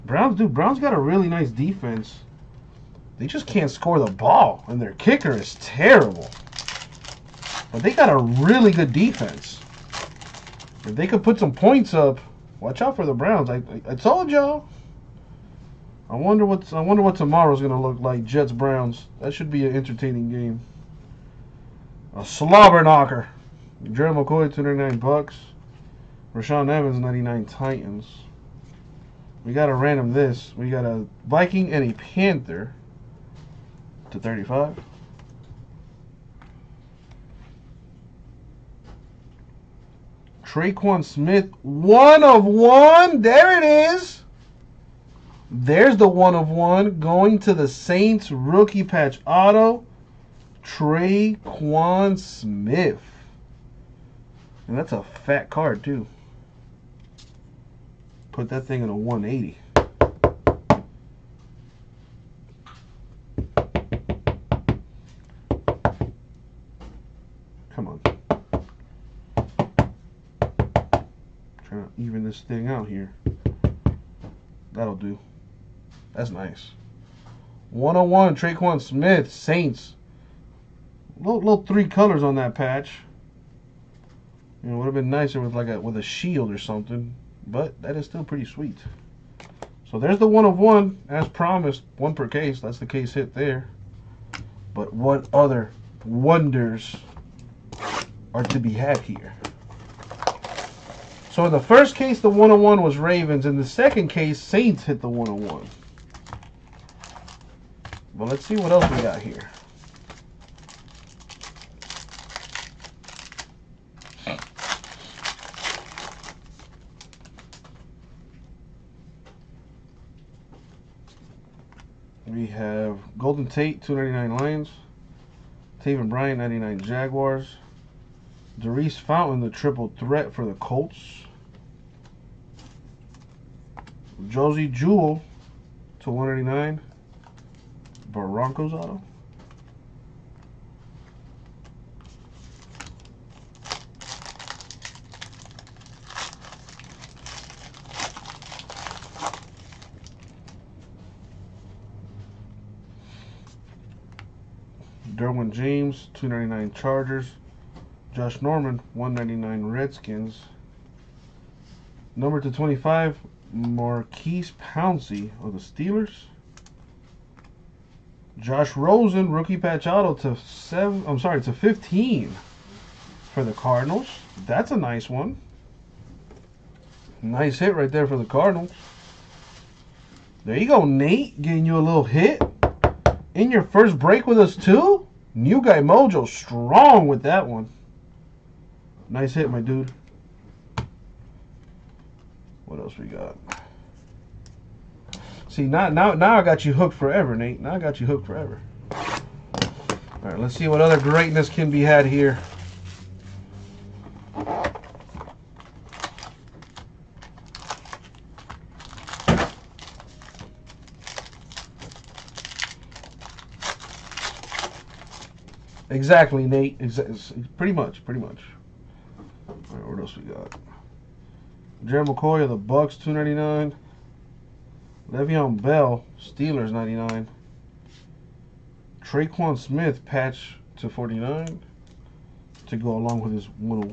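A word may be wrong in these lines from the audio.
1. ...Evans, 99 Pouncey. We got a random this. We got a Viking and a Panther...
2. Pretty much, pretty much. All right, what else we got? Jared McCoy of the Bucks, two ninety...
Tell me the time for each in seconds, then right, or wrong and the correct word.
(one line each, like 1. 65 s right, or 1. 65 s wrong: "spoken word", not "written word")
1. 26 s wrong: "Titans", not "Pouncey"
2. 217 s right.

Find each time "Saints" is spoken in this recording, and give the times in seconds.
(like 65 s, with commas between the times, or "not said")
47 s, 79 s, 104 s.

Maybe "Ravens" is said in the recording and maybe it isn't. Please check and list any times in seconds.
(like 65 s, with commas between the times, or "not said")
102 s.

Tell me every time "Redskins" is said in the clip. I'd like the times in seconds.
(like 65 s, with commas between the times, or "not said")
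159 s.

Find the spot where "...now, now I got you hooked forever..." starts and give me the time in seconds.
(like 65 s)
195 s.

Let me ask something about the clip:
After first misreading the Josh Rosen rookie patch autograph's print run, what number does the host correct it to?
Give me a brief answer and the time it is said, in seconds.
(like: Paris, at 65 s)
15, at 171 s.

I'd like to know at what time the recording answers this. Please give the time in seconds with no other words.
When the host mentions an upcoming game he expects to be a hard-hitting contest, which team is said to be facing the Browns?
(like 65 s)
18 s.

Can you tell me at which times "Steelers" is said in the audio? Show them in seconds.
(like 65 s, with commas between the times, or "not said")
165 s, 226 s.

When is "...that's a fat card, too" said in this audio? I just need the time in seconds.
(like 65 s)
54 s.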